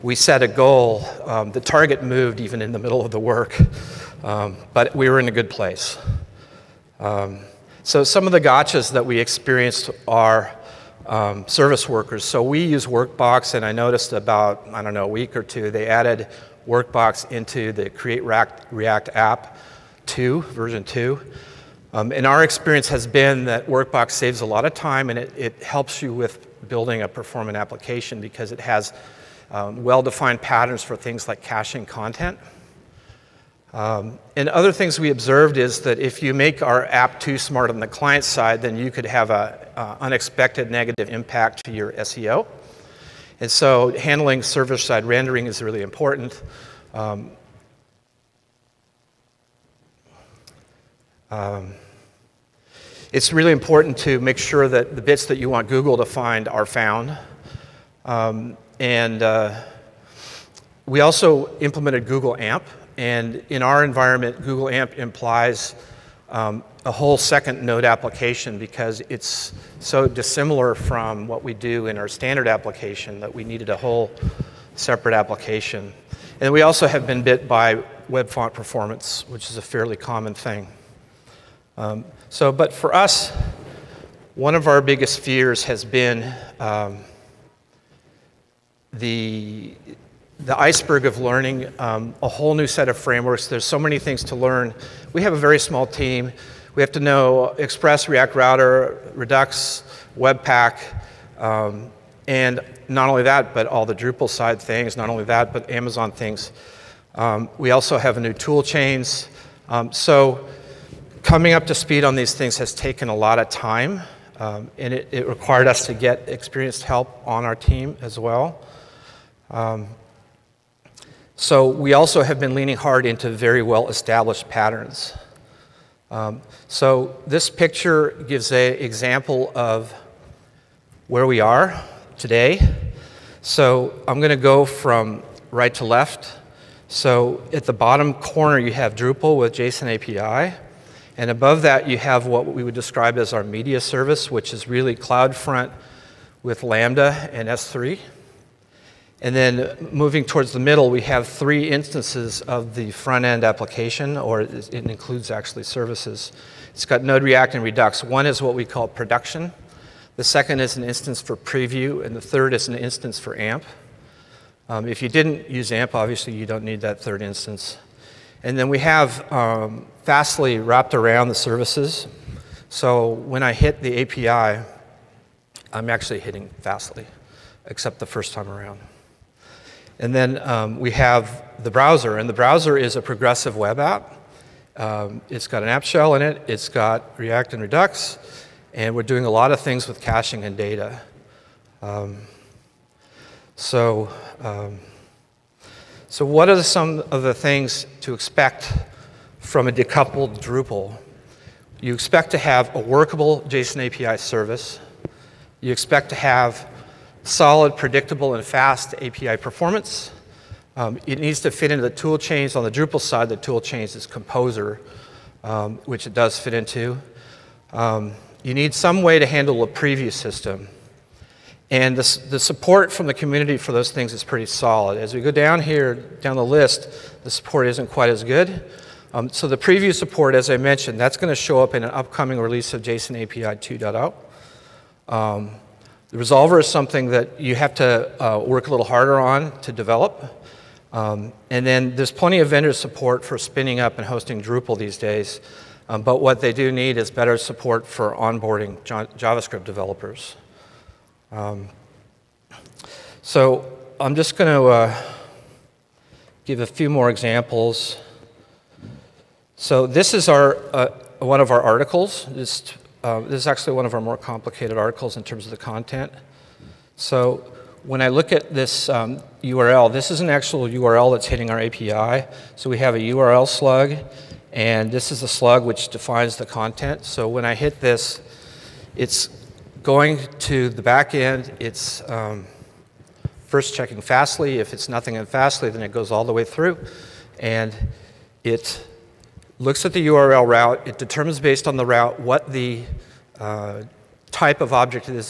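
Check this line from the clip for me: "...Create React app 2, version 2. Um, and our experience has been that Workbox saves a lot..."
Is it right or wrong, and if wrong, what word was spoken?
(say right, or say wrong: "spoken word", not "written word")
right.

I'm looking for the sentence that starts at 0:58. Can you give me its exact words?
Um, and uh, we also implemented Google AMP.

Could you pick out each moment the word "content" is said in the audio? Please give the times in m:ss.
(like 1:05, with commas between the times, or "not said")
0:31, 4:25, 4:36.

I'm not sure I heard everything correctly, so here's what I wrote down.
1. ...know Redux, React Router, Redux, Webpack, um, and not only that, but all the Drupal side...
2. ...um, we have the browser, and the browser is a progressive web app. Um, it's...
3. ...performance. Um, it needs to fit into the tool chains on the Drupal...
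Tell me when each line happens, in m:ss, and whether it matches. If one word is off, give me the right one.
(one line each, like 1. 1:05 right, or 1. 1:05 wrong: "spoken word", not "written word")
1. 1:36 wrong: "Express", not "Redux"
2. 3:00 right
3. 3:29 right.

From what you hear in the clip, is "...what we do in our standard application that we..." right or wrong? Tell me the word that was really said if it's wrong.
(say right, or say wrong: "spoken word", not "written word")
right.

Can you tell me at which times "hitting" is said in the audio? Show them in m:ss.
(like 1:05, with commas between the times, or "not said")
2:56, 4:31.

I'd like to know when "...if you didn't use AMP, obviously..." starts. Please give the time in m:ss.
2:44.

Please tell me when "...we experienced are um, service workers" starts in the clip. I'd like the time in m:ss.
0:09.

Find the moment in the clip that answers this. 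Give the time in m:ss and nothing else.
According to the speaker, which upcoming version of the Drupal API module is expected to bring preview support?
3:52.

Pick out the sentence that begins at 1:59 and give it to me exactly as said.
Um, so we also have been leaning hard into very well-established patterns.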